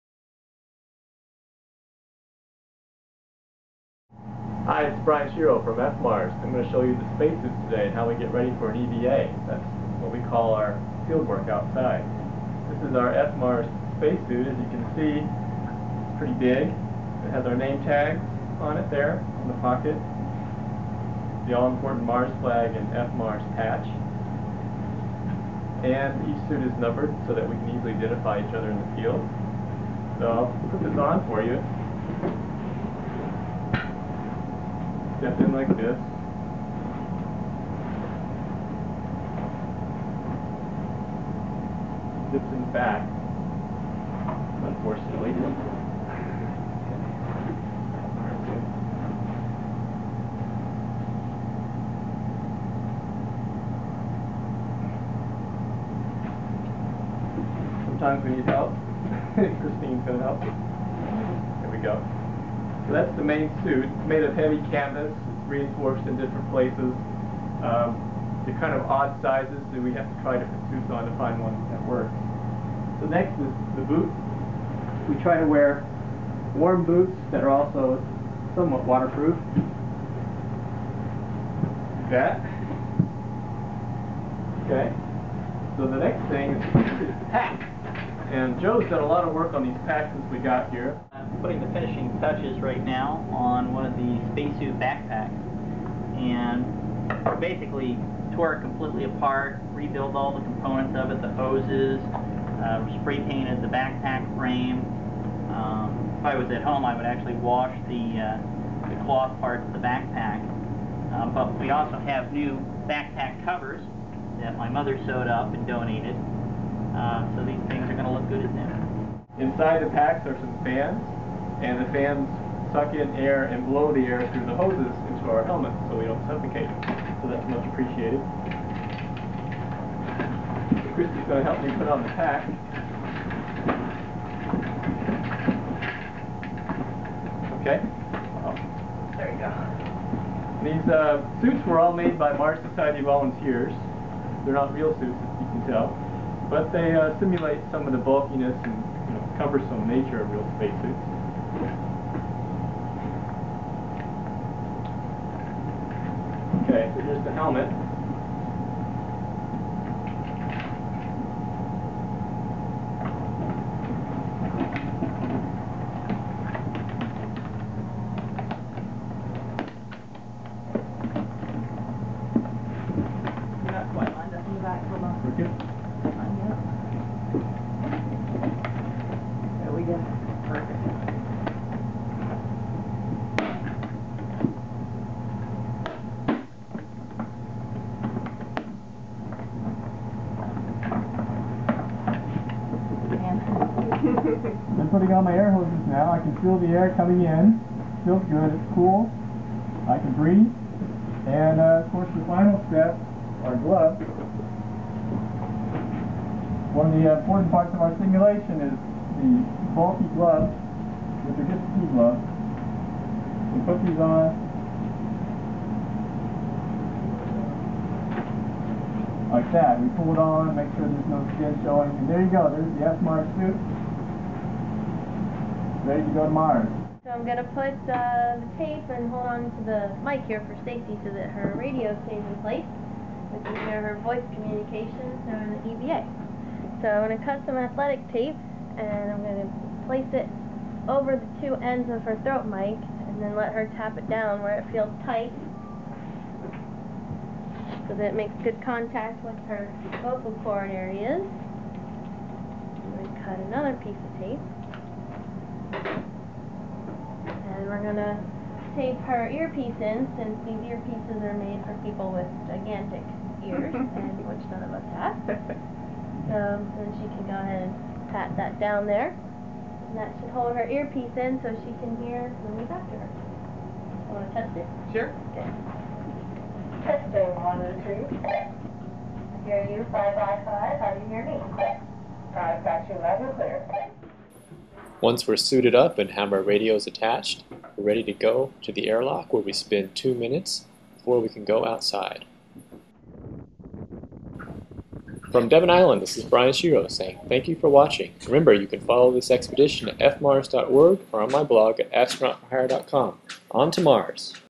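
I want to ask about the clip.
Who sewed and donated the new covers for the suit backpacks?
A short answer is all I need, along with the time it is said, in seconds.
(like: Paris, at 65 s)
my mother, at 114 s.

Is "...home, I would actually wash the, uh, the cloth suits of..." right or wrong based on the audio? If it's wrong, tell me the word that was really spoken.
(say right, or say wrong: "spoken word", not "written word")
wrong: "parts", not "suits".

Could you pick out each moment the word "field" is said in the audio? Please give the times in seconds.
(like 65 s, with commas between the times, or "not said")
11 s, 28 s.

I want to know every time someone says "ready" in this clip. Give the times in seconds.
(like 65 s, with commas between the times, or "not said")
8 s, 225 s, 287 s.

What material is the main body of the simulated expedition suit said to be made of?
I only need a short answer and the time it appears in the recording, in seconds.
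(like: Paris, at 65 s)
heavy canvas, at 64 s.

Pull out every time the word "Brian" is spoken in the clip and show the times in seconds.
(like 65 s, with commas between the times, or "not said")
5 s, 296 s.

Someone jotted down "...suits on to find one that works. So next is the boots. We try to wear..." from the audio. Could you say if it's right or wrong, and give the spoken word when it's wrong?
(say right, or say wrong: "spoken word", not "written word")
right.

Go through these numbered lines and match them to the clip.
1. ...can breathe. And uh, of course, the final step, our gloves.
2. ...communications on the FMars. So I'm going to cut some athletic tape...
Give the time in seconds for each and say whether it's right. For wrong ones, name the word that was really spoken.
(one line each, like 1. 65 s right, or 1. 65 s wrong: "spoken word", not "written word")
1. 200 s right
2. 234 s wrong: "EVA", not "FMars".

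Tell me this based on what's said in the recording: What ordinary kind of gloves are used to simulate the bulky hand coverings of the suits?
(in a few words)
ski gloves.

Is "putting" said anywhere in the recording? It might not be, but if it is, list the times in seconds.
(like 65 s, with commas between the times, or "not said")
91 s, 194 s.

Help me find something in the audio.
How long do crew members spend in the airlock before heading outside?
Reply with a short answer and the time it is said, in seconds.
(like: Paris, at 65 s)
2 minutes, at 289 s.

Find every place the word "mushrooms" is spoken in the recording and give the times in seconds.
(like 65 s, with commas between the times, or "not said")
not said.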